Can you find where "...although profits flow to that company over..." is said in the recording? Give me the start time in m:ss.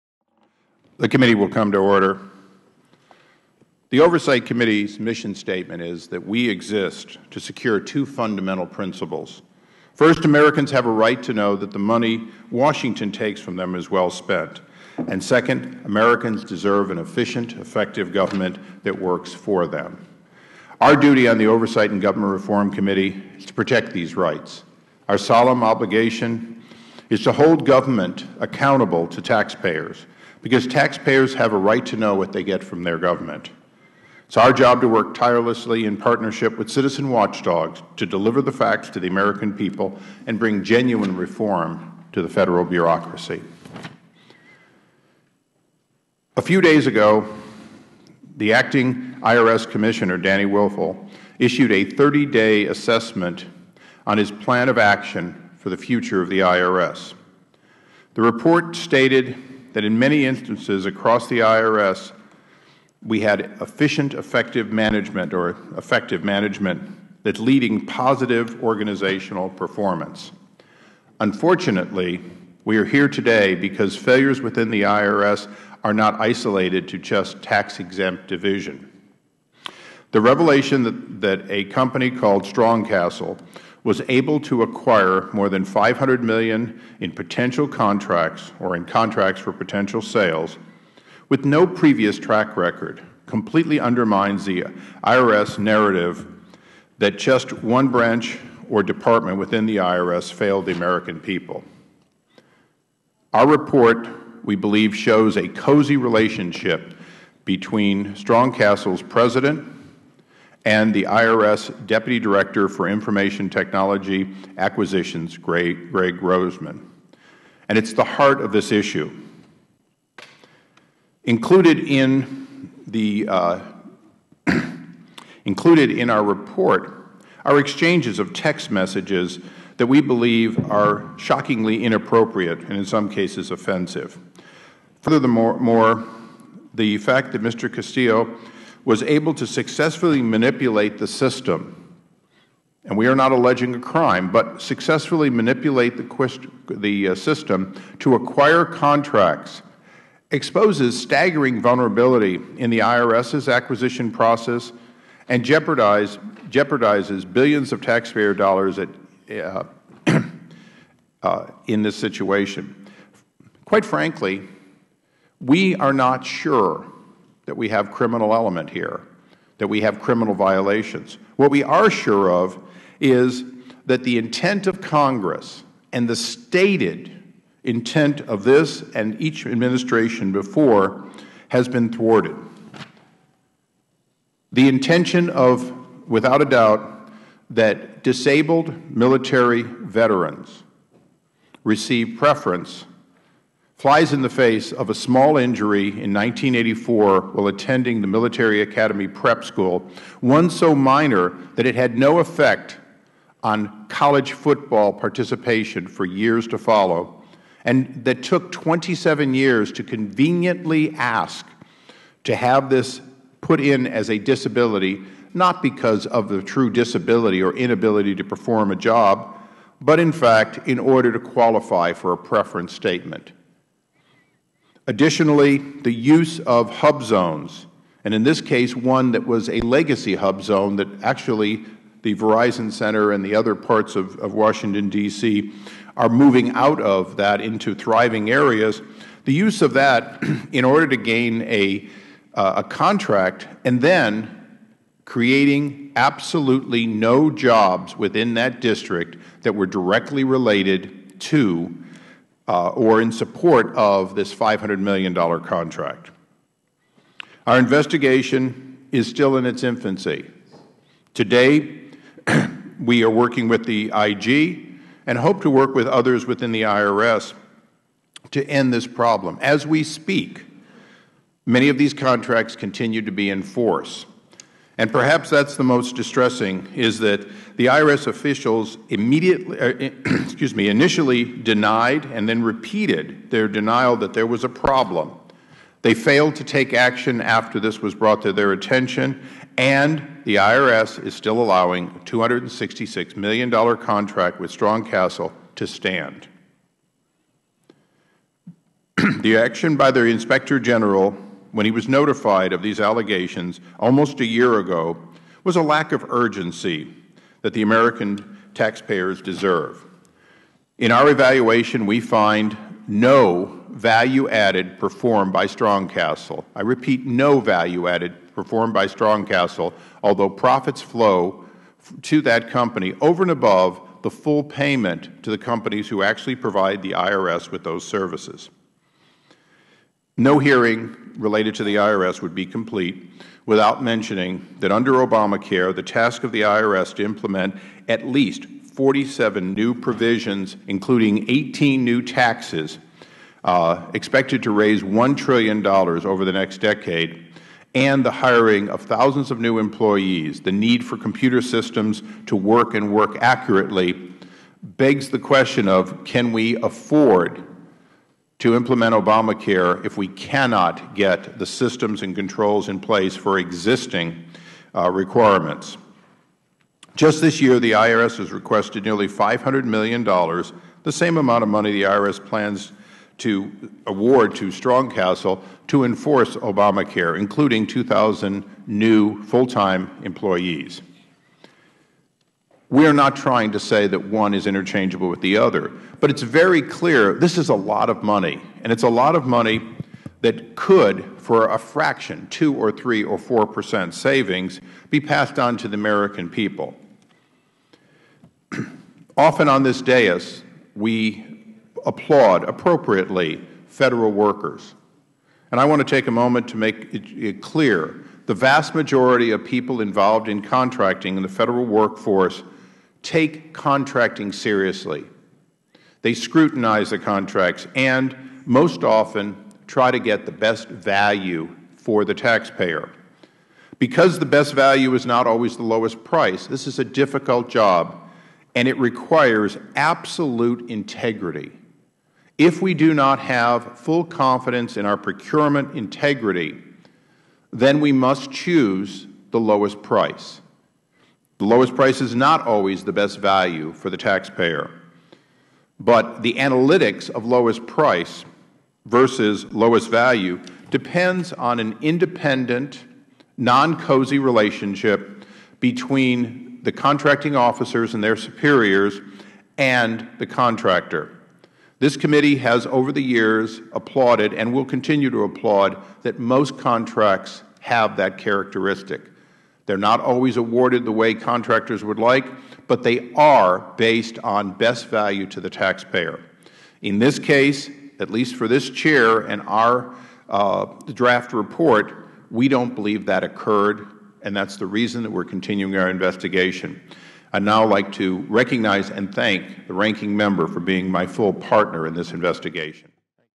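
5:20.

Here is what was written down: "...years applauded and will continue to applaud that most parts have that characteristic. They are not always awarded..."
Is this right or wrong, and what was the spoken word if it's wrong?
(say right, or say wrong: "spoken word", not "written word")
wrong: "contracts", not "parts".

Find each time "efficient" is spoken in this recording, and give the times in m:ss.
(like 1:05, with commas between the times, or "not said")
0:16, 1:03.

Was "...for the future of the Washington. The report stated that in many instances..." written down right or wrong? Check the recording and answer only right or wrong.
wrong.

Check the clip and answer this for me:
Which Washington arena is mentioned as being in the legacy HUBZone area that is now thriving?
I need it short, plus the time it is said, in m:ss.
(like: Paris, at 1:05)
Verizon Center, at 3:52.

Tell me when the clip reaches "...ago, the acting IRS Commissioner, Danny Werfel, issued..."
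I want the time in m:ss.
0:46.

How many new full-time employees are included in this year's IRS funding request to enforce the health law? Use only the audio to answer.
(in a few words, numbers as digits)
2,000.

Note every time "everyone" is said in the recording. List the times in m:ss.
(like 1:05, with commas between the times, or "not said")
not said.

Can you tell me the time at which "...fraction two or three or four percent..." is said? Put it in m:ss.
6:31.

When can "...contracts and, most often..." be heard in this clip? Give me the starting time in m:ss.
6:56.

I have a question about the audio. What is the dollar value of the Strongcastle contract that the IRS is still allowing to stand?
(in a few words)
$266 million.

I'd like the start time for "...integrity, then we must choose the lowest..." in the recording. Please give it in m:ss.
7:15.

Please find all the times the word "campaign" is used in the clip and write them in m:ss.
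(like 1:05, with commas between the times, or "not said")
not said.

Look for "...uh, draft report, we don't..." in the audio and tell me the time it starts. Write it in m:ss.
8:00.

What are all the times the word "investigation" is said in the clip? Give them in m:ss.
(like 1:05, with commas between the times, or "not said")
4:17, 8:05, 8:12.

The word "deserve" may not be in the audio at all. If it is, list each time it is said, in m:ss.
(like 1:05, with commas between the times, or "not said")
0:16, 5:09.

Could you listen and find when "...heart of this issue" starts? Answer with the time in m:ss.
1:58.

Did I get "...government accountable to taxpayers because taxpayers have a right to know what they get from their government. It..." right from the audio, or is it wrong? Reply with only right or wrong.
right.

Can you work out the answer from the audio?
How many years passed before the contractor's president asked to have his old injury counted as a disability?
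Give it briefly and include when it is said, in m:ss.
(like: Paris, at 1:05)
27, at 3:28.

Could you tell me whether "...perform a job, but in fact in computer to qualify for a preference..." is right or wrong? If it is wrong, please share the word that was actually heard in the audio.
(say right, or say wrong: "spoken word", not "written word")
wrong: "order", not "computer".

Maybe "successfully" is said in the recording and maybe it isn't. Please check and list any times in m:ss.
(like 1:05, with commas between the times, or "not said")
2:19, 2:24.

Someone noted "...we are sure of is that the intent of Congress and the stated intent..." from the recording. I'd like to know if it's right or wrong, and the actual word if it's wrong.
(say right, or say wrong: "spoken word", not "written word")
right.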